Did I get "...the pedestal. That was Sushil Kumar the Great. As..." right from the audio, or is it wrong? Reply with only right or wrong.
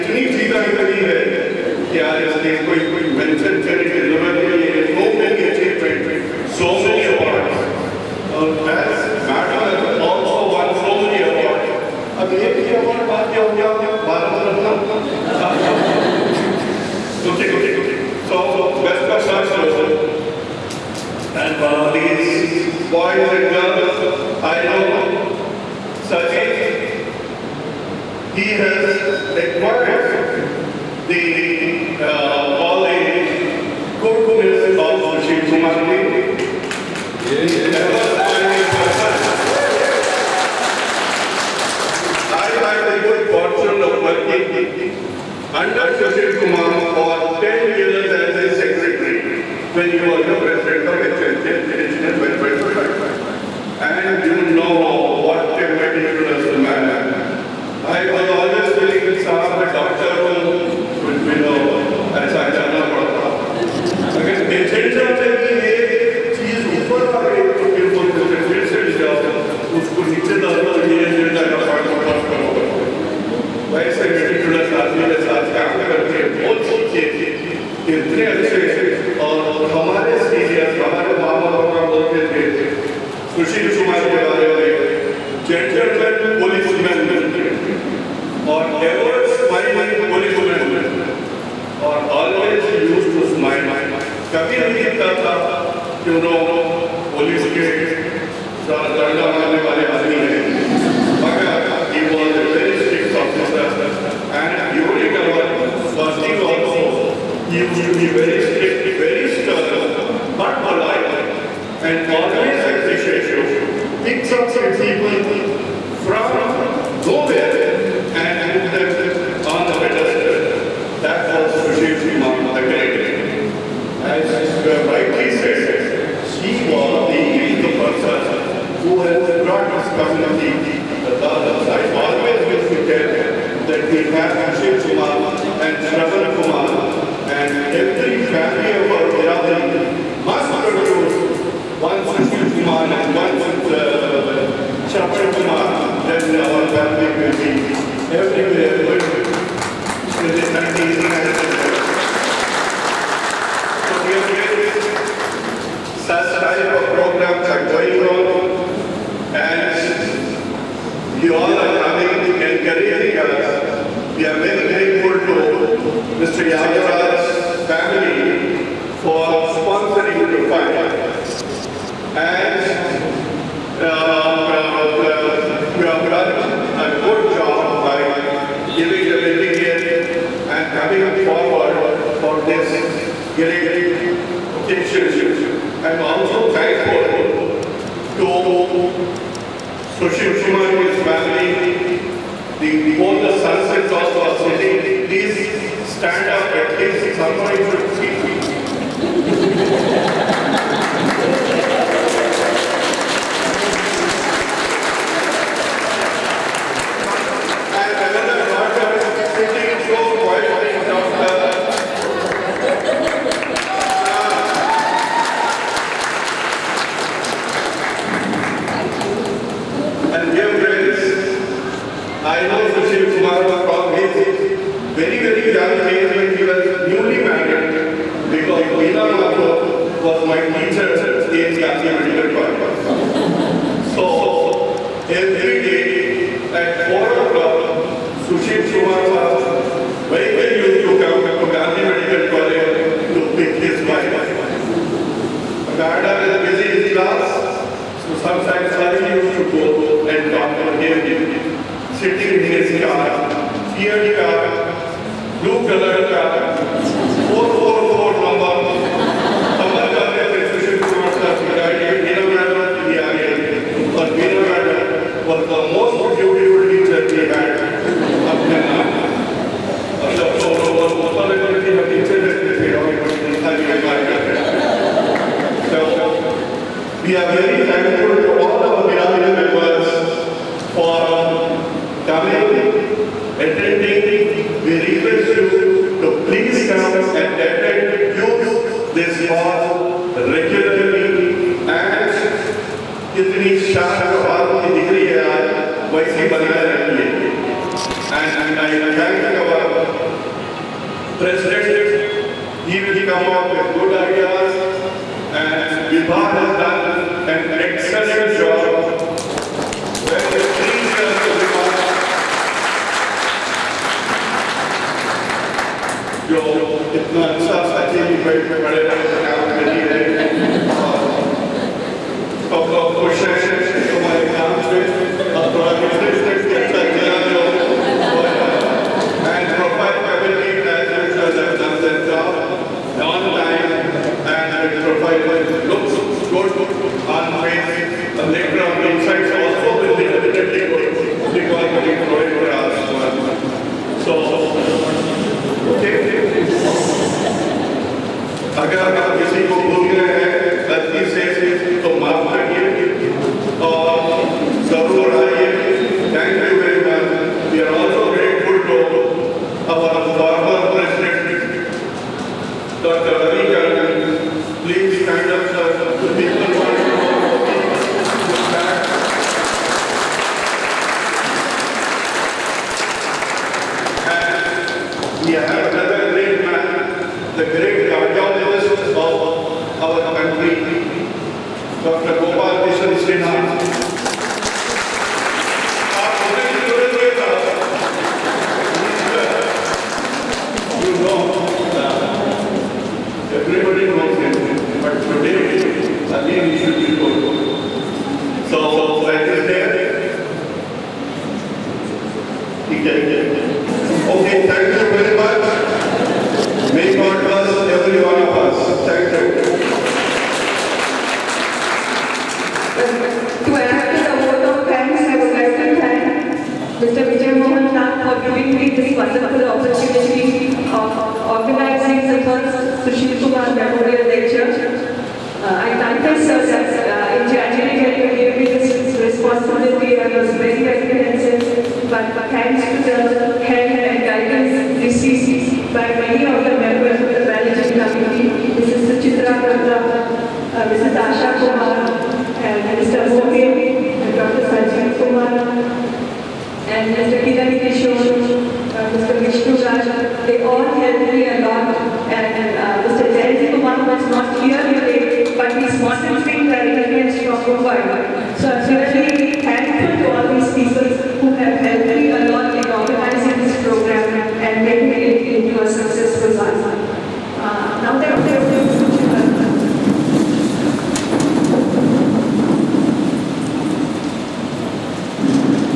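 right.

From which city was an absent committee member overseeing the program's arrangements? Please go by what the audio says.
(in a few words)
Mumbai.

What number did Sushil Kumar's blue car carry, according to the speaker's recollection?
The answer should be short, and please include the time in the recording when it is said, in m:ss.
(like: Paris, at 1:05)
444, at 4:16.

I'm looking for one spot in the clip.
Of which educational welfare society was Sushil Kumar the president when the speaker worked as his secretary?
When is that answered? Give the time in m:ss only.
0:51.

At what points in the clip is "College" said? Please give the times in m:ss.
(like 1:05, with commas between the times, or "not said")
3:52, 4:02.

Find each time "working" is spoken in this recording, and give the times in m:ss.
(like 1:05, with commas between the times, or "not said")
0:44.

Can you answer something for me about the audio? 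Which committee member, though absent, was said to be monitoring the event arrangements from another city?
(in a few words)
Jayant Kumar.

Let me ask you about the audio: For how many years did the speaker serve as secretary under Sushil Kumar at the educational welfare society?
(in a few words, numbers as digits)
10 years.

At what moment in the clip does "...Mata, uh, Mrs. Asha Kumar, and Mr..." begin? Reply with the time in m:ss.
7:19.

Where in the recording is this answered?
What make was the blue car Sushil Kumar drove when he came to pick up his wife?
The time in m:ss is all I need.
4:13.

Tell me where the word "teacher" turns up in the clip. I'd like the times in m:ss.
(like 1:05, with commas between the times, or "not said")
3:50, 4:26.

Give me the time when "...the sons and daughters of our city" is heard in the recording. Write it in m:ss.
3:13.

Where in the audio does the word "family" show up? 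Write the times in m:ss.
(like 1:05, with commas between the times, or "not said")
2:18, 2:26, 2:47, 3:11.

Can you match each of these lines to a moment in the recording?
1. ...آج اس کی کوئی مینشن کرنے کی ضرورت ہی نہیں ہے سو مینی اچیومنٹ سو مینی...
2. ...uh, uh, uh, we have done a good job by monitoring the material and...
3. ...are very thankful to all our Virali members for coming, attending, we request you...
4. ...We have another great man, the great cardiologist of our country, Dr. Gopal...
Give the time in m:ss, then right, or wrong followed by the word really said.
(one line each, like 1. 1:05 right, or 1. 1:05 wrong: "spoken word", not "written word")
1. 0:02 right
2. 2:53 wrong: "giving", not "monitoring"
3. 4:37 right
4. 6:15 right.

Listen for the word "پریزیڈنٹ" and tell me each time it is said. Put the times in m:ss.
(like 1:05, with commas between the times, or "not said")
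6:00.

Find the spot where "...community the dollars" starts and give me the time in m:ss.
2:09.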